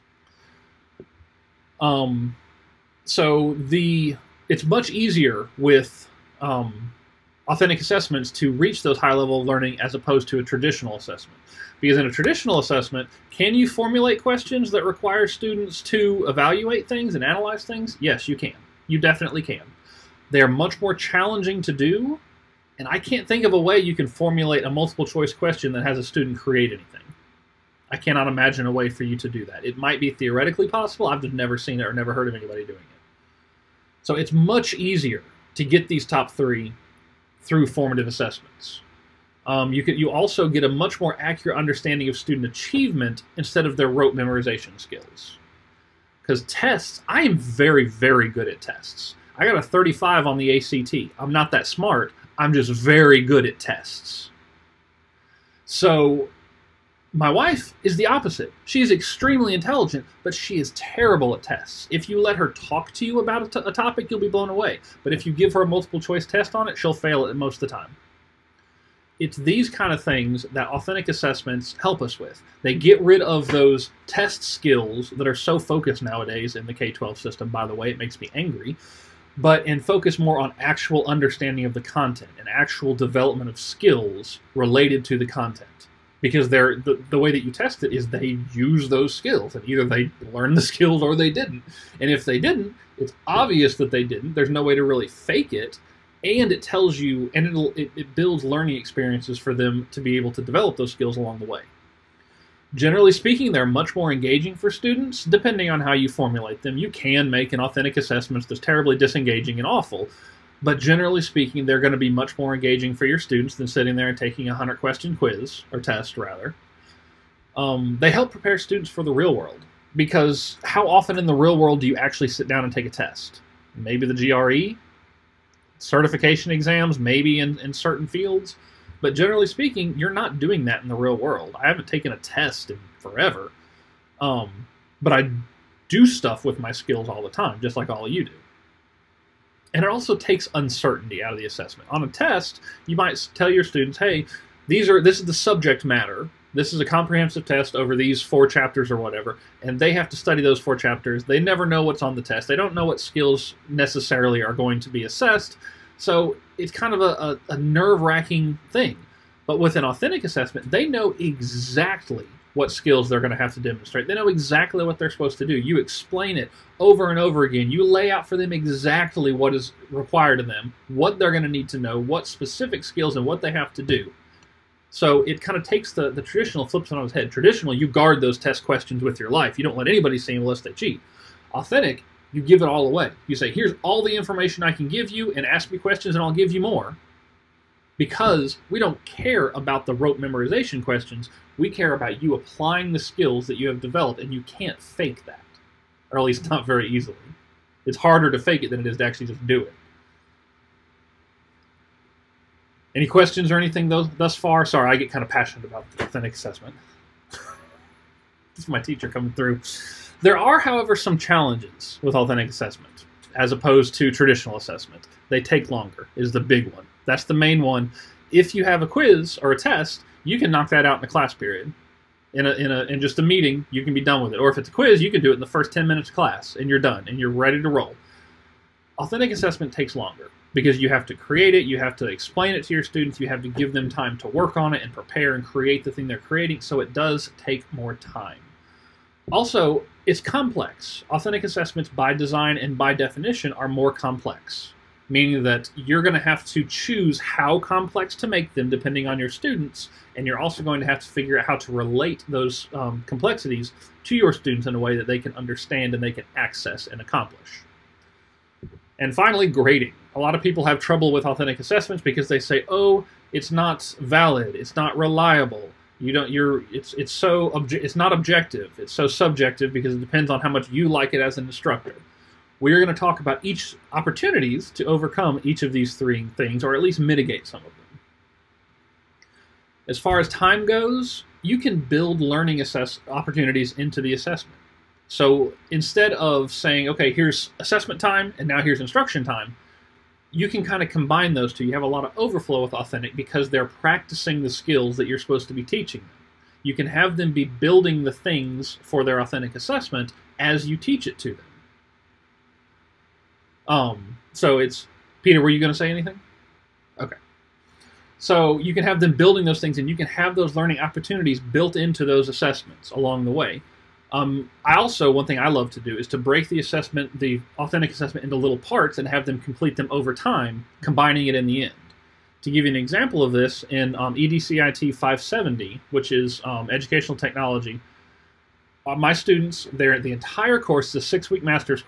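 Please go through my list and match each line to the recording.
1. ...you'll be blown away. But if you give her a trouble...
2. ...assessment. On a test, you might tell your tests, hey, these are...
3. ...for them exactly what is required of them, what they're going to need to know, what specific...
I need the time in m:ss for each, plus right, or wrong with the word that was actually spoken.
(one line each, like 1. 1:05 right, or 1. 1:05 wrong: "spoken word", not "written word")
1. 1:04 wrong: "multiple", not "trouble"
2. 2:21 wrong: "students", not "tests"
3. 2:48 right.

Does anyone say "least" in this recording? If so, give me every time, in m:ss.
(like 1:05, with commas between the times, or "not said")
3:16, 4:36.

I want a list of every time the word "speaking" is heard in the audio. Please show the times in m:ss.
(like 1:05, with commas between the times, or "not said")
1:43, 1:51, 2:09.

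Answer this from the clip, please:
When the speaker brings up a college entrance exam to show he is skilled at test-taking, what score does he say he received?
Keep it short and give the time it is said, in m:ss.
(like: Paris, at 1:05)
35, at 0:49.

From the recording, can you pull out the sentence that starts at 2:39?
But with an authentic assessment, they know exactly what skills they're going to have to demonstrate.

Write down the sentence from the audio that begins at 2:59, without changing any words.
You don't let anybody see them unless they cheat.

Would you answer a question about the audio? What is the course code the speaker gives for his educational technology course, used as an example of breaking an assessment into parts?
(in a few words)
EDCIT 570.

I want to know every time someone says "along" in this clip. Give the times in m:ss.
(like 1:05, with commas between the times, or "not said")
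1:41, 5:12.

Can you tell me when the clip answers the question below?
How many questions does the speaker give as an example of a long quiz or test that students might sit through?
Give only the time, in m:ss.
1:54.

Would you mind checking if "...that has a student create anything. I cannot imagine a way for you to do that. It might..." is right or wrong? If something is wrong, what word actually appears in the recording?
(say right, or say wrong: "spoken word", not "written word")
right.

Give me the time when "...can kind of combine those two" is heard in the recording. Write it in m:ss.
4:50.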